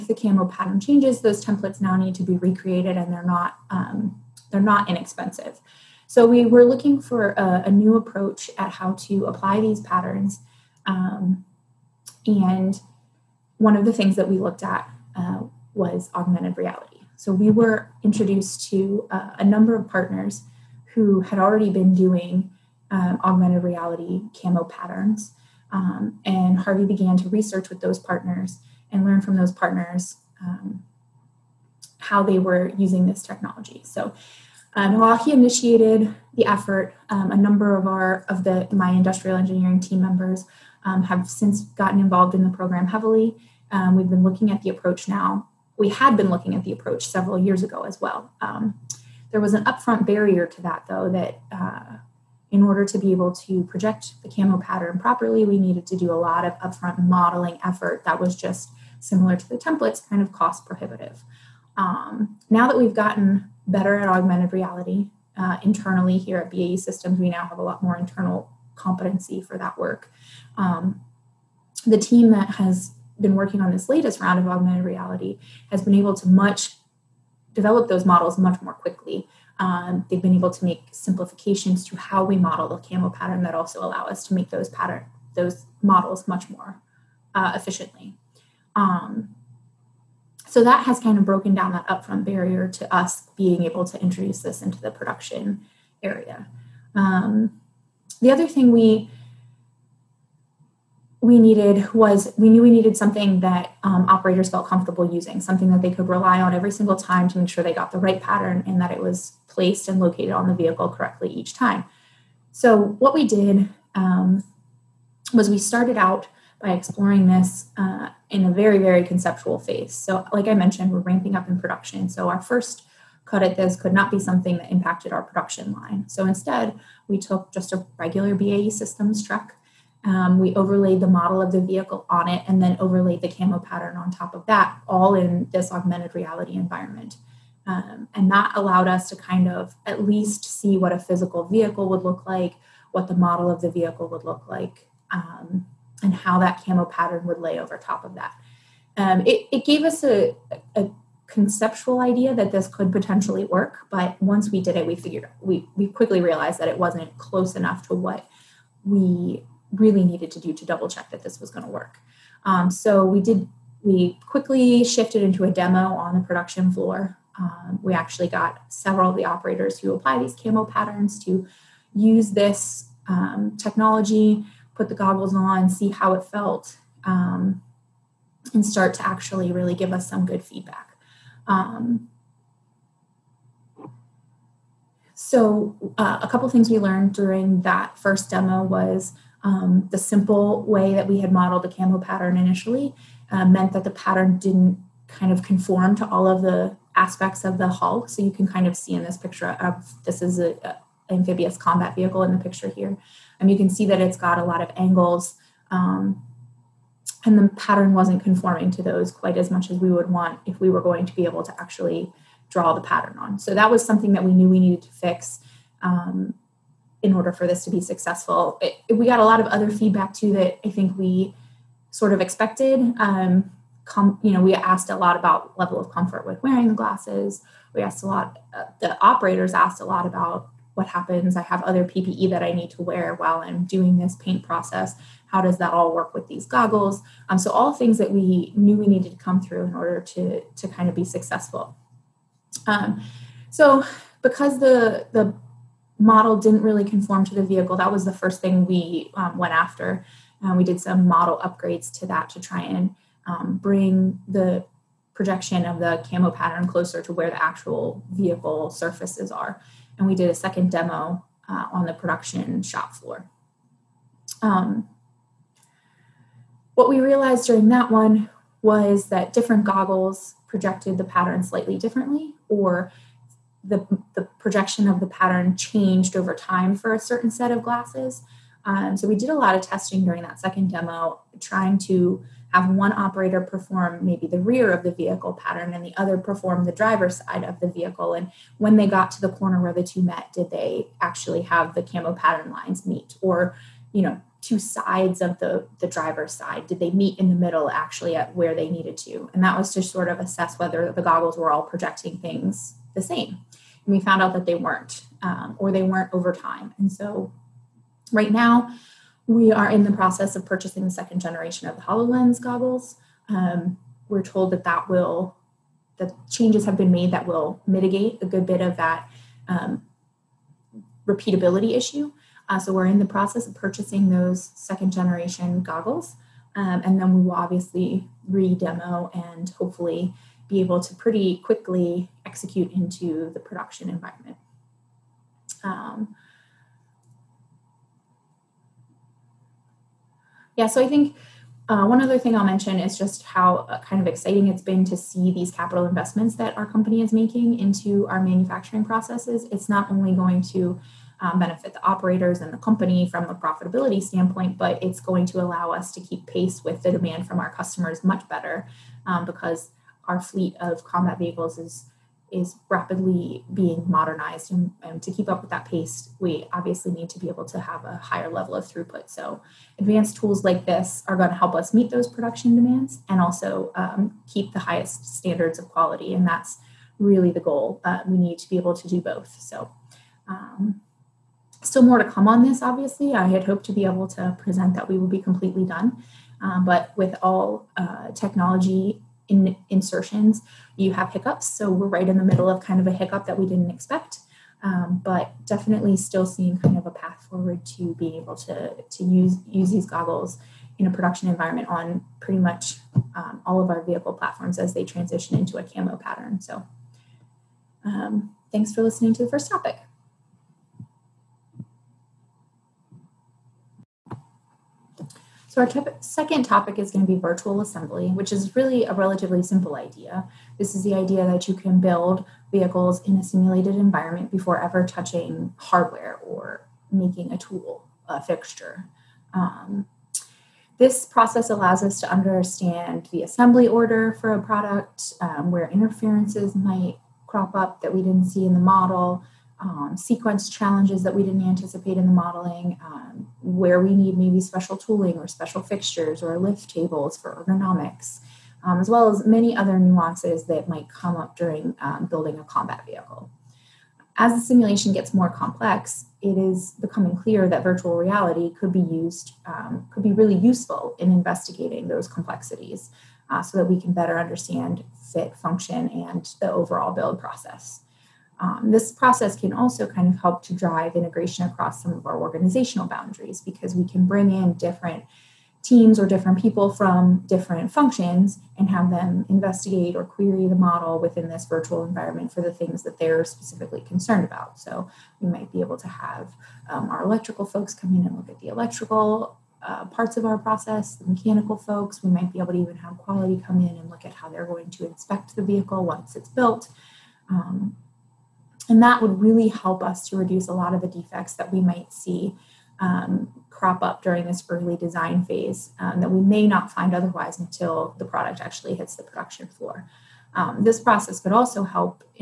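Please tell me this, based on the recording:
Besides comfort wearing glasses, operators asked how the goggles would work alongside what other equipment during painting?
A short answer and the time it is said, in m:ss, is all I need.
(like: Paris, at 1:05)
PPE, at 3:51.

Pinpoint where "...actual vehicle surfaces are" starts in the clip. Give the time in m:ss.
4:17.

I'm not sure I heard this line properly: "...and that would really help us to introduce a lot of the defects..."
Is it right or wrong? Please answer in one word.
wrong.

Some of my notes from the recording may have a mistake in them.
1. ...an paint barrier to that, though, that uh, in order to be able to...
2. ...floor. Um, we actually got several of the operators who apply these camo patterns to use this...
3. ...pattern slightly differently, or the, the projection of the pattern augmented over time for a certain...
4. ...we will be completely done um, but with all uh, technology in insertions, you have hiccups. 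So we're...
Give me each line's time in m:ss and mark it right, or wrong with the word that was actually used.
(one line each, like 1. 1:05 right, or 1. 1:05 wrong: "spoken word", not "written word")
1. 0:49 wrong: "upfront", not "paint"
2. 2:46 right
3. 4:31 wrong: "changed", not "augmented"
4. 6:24 right.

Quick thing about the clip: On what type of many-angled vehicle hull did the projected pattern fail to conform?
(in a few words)
amphibious combat vehicle.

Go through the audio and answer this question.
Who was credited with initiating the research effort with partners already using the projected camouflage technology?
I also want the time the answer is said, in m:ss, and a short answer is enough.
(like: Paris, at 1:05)
Harvey, at 0:26.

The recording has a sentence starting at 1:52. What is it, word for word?
So, what we did um, was we started out by exploring this uh, in a very, very conceptual phase.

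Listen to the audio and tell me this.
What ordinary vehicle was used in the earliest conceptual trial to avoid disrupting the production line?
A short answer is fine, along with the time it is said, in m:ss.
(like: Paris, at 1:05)
a regular BAE Systems truck, at 2:07.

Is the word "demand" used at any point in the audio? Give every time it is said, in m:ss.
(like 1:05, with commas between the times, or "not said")
5:56, 6:12.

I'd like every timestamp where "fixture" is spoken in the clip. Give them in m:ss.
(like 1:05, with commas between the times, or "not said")
7:08, 7:25.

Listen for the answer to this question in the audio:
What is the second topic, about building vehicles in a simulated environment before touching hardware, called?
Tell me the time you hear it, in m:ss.
6:57.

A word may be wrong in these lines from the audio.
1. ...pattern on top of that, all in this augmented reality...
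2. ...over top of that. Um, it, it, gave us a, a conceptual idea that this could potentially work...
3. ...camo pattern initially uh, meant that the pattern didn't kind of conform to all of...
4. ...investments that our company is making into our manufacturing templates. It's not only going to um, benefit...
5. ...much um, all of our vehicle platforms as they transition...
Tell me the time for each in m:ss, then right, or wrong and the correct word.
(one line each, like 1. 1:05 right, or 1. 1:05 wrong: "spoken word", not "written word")
1. 2:13 right
2. 2:27 right
3. 3:11 right
4. 5:45 wrong: "processes", not "templates"
5. 6:42 right.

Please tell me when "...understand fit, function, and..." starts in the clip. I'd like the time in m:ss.
7:44.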